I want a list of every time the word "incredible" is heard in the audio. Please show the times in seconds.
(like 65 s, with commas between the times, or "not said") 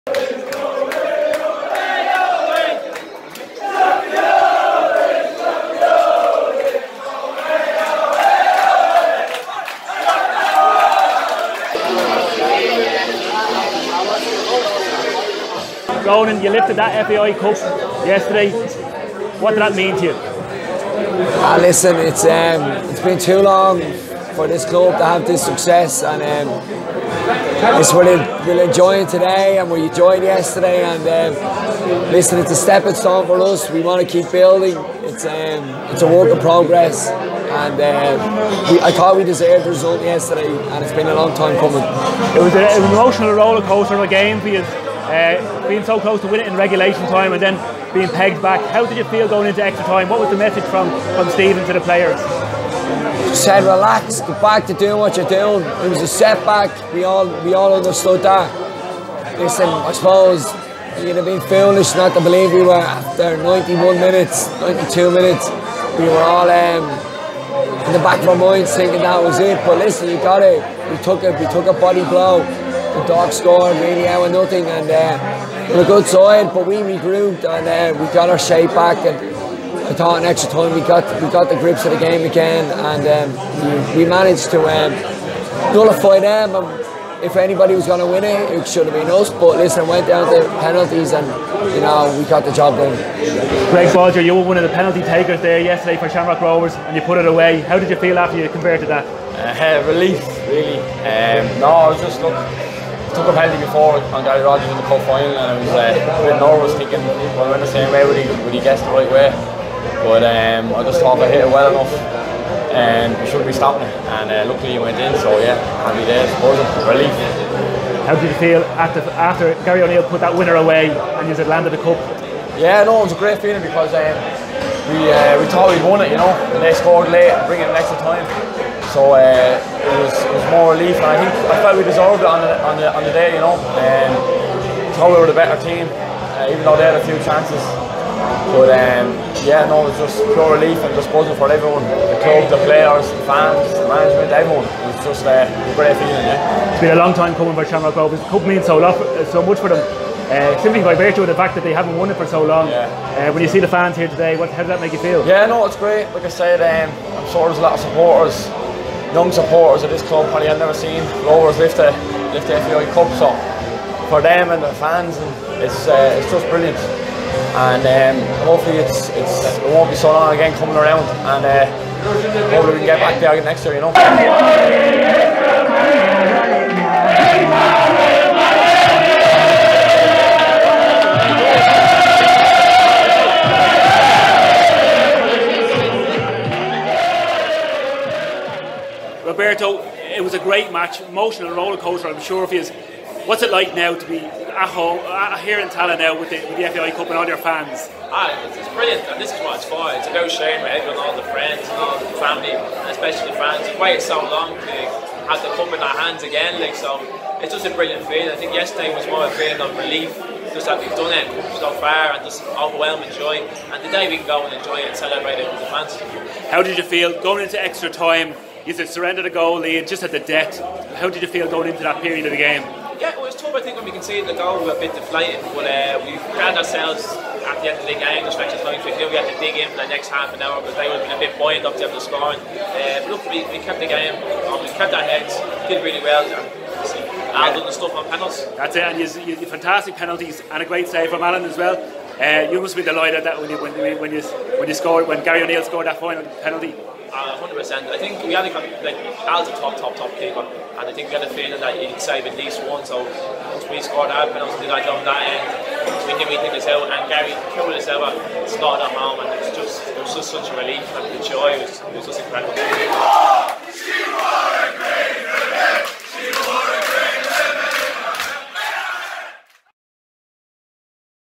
262 s.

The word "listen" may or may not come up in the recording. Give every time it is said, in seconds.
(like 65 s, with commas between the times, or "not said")
21 s, 32 s, 59 s, 69 s, 89 s.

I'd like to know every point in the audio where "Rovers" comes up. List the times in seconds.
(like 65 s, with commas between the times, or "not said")
96 s, 147 s, 161 s.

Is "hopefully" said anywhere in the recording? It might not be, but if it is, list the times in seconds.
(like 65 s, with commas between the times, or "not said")
168 s, 172 s.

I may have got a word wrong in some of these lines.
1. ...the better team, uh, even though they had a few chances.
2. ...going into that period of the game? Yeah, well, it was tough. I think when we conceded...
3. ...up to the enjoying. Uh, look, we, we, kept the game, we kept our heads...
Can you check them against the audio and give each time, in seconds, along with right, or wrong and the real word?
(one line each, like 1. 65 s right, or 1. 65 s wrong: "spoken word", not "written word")
1. 135 s right
2. 221 s right
3. 231 s wrong: "scoring", not "enjoying".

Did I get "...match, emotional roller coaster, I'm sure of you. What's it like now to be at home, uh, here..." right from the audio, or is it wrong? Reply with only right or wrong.
right.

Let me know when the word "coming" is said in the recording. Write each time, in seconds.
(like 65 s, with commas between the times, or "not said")
41 s, 147 s, 170 s.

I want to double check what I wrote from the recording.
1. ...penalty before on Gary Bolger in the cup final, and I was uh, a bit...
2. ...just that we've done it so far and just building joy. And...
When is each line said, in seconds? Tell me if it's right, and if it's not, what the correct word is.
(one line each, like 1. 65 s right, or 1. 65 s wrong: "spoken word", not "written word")
1. 103 s wrong: "Rogers", not "Bolger"
2. 210 s wrong: "overwhelming", not "building".